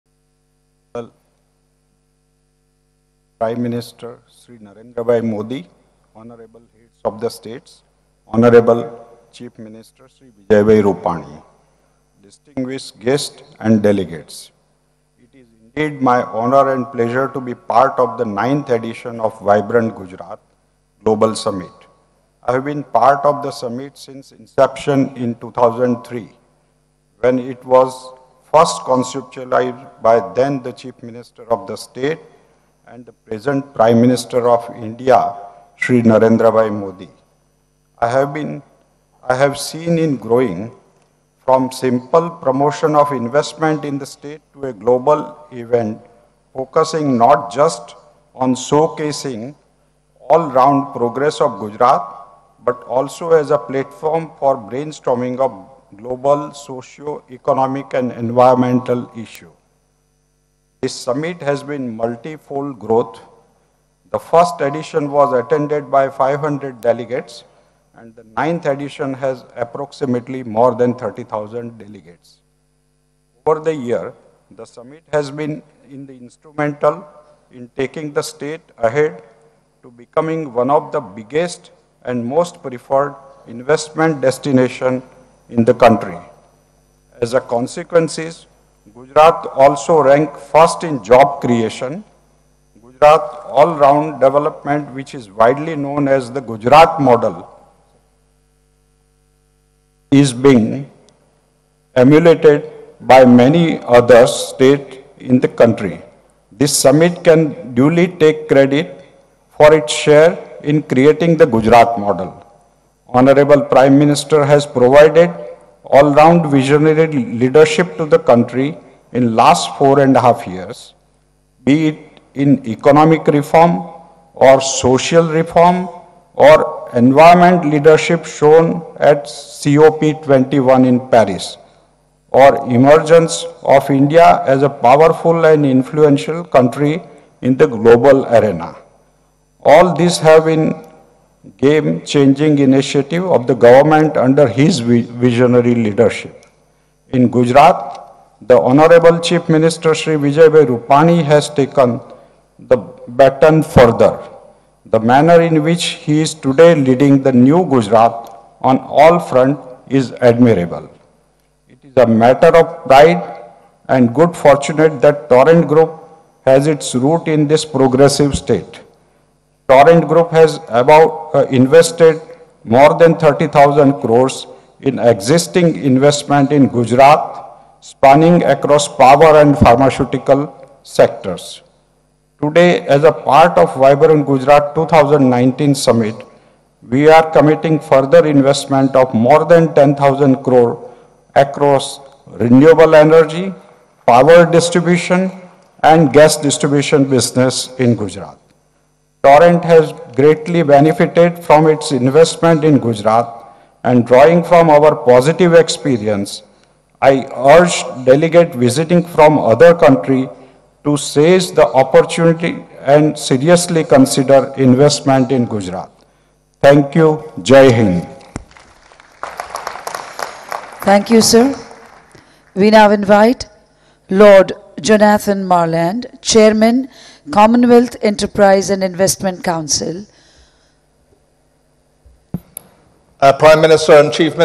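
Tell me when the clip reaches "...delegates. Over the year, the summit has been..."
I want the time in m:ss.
1:11.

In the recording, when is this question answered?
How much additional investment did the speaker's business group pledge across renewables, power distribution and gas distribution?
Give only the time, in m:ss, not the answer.
3:09.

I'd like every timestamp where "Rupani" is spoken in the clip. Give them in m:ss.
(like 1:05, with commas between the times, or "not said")
0:10, 2:30.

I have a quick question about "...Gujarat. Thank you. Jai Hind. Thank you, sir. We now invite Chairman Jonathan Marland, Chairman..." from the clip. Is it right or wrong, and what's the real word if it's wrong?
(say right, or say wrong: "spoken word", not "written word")
wrong: "Lord", not "Chairman".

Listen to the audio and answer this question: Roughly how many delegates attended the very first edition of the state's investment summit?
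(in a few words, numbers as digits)
500.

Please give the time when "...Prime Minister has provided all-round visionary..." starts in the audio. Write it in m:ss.
1:53.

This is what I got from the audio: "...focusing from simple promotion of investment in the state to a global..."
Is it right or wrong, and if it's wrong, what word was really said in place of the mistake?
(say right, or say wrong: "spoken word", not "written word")
wrong: "growing", not "focusing".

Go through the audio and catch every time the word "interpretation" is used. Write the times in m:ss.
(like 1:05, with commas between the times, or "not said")
not said.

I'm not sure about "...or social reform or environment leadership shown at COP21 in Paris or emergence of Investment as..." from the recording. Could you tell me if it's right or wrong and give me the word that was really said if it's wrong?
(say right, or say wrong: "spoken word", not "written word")
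wrong: "India", not "Investment".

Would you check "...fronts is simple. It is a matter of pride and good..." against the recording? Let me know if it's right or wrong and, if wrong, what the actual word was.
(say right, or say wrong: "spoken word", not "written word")
wrong: "admirable", not "simple".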